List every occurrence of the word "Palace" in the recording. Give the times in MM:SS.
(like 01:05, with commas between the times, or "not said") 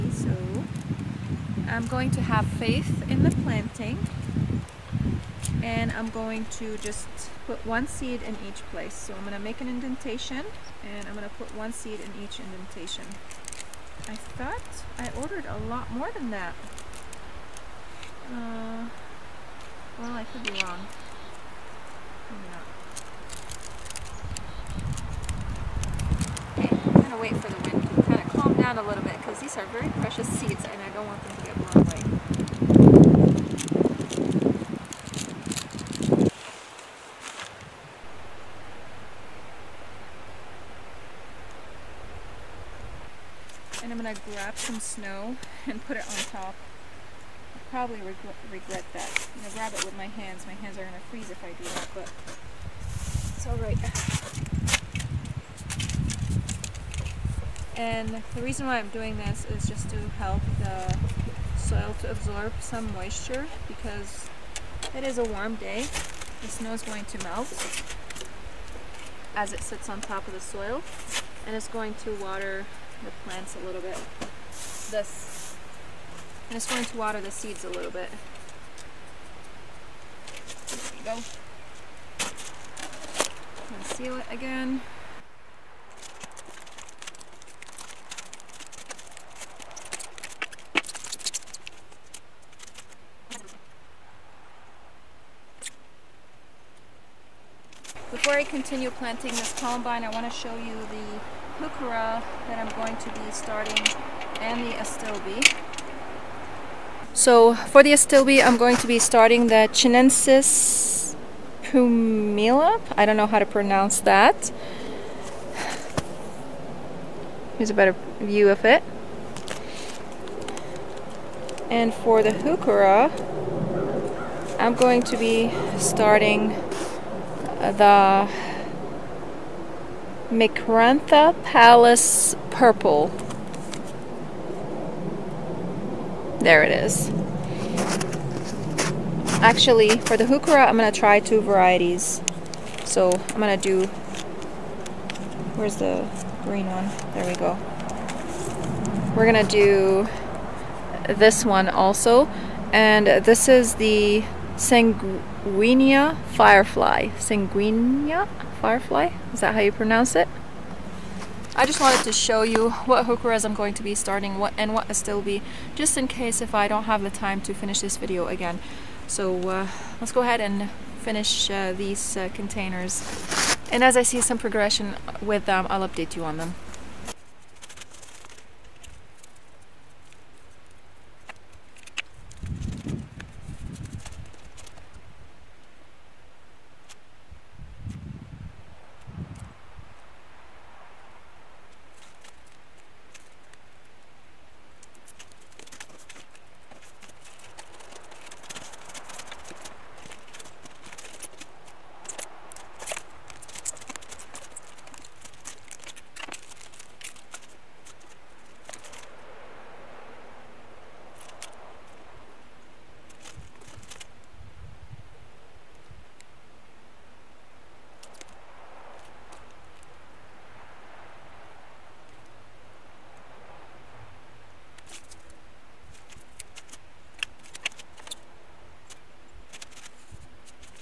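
02:11.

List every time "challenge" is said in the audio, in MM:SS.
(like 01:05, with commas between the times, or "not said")
not said.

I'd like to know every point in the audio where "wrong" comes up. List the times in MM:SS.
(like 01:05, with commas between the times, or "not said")
00:20.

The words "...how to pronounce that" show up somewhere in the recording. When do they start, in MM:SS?
01:53.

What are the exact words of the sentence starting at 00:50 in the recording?
My hands are going to freeze if I do that, but it's alright.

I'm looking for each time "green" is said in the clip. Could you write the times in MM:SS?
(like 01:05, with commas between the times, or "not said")
02:26.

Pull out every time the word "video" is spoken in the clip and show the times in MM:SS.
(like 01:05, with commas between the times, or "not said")
02:47.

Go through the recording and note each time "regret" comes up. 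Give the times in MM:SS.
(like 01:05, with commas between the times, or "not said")
00:48.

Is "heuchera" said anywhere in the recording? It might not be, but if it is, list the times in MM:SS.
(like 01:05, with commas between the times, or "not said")
01:41, 02:02, 02:20, 02:43.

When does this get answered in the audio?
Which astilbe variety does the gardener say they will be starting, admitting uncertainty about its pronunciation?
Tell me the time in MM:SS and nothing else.
01:49.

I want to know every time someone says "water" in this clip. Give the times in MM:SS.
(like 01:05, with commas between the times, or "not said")
01:12, 01:16.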